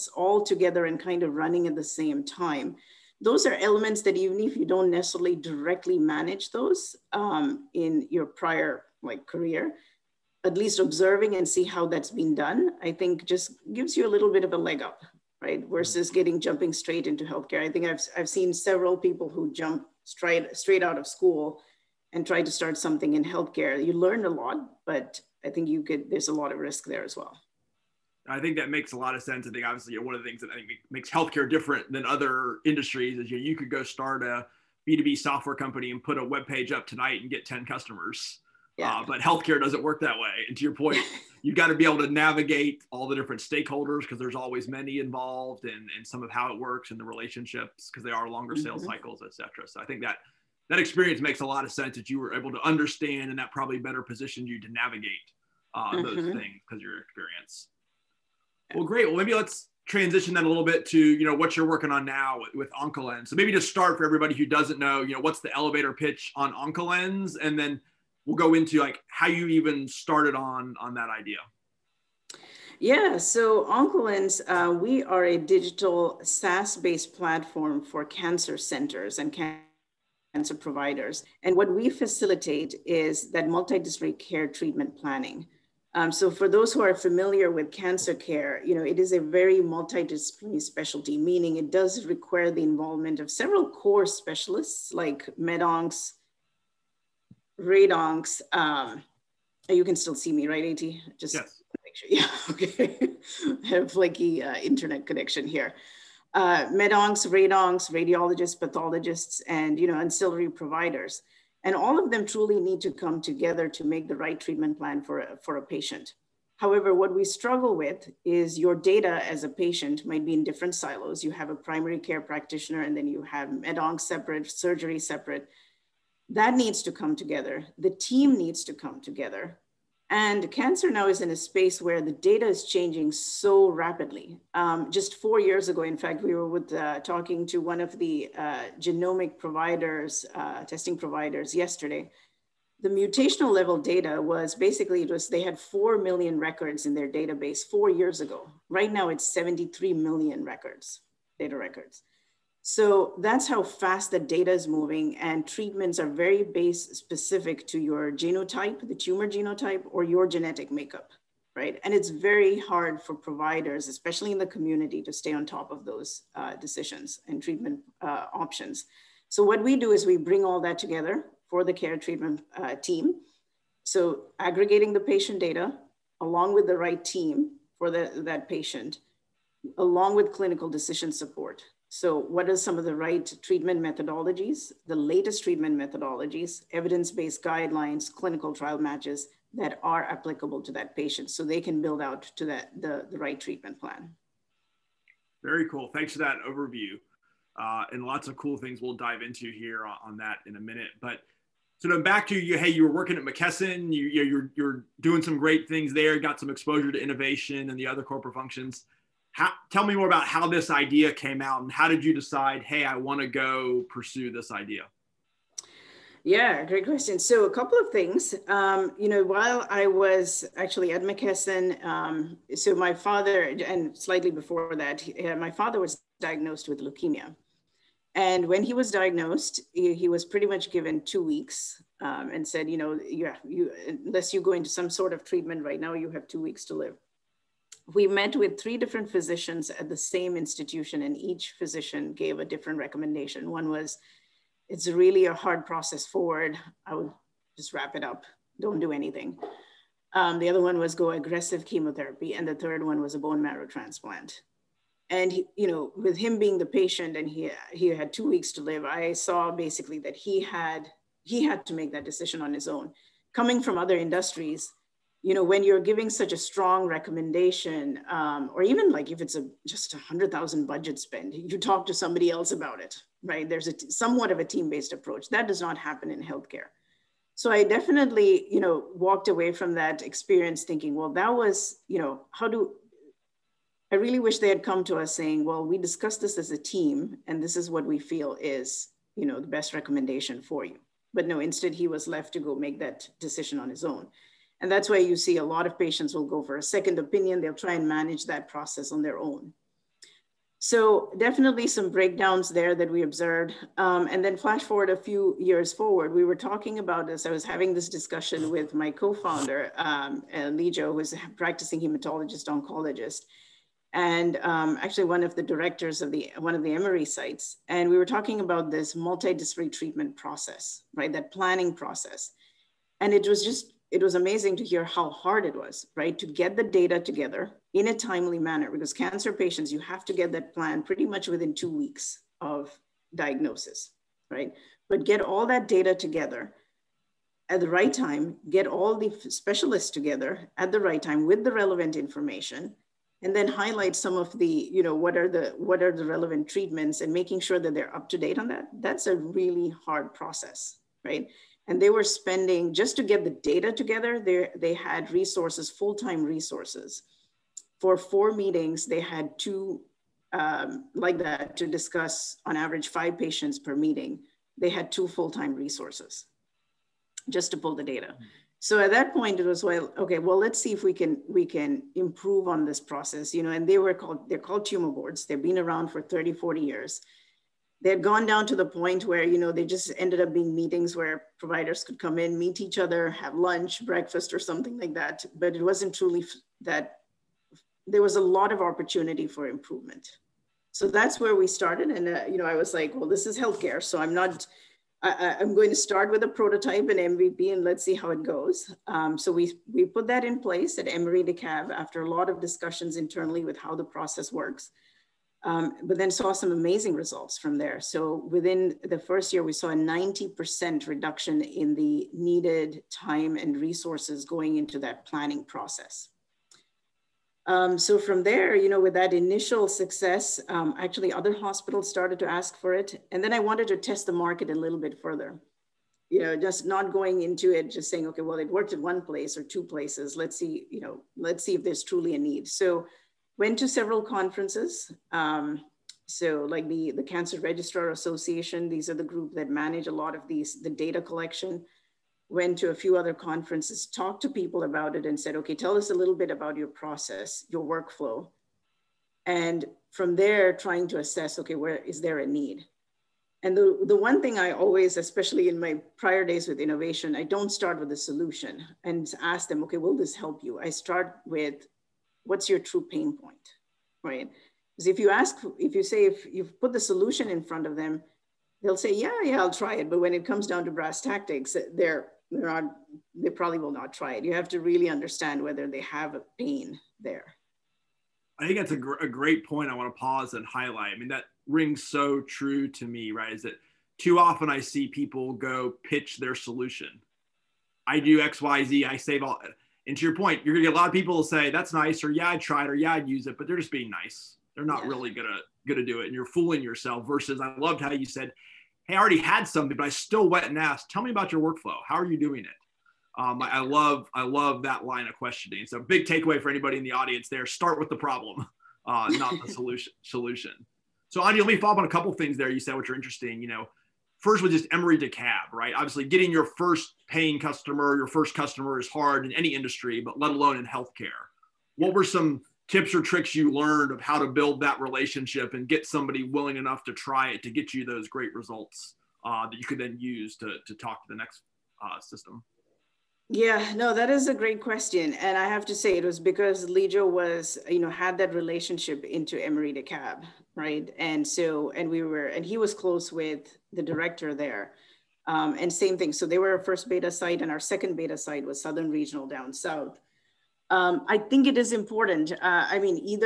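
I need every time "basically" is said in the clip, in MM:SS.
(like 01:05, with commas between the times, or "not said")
02:24, 04:19.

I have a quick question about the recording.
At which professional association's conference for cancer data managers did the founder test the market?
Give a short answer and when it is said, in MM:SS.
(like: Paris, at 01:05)
Cancer Registrar Association, at 07:17.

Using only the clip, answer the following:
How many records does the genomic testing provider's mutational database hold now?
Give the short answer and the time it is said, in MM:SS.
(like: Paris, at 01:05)
73 million, at 02:29.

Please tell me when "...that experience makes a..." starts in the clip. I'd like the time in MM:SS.
00:50.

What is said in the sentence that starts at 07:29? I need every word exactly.
And from there, trying to assess, okay, where is there a need?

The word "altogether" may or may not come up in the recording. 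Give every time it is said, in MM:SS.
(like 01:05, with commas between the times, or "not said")
not said.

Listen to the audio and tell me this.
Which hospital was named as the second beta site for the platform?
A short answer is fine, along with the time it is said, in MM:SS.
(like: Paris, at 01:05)
Southern Regional, at 09:08.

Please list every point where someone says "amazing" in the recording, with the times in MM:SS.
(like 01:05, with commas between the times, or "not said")
05:24, 06:46.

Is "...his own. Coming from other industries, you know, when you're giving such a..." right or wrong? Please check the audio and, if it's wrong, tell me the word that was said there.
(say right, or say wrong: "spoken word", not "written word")
right.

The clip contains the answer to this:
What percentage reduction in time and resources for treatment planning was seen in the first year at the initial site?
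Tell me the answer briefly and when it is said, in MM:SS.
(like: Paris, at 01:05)
90%, at 06:49.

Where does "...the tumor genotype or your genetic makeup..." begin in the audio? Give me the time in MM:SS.
02:38.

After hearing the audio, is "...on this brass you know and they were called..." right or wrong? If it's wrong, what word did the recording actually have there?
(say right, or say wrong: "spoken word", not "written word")
wrong: "process", not "brass".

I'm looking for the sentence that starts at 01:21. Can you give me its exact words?
And what we facilitate is that multidisciplinary care treatment planning.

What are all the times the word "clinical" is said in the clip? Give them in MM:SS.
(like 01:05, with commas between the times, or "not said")
03:00, 03:08.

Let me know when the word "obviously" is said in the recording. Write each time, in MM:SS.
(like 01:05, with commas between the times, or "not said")
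00:29, 08:35.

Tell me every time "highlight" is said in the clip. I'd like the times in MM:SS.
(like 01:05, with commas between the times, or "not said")
05:43, 08:00.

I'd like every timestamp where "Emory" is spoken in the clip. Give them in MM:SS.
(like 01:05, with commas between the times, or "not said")
05:16, 06:40, 08:34, 08:59.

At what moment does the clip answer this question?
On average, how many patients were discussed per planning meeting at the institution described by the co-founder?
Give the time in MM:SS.
06:02.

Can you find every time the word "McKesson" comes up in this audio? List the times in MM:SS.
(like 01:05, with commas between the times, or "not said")
03:23, 03:41.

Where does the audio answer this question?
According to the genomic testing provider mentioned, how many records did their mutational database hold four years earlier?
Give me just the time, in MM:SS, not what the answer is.
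02:25.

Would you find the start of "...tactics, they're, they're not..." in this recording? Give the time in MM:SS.
07:51.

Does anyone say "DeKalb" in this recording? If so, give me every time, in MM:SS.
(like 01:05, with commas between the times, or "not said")
06:41, 08:34, 08:59.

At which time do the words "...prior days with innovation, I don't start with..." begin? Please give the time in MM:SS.
07:35.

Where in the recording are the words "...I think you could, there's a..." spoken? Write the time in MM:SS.
00:25.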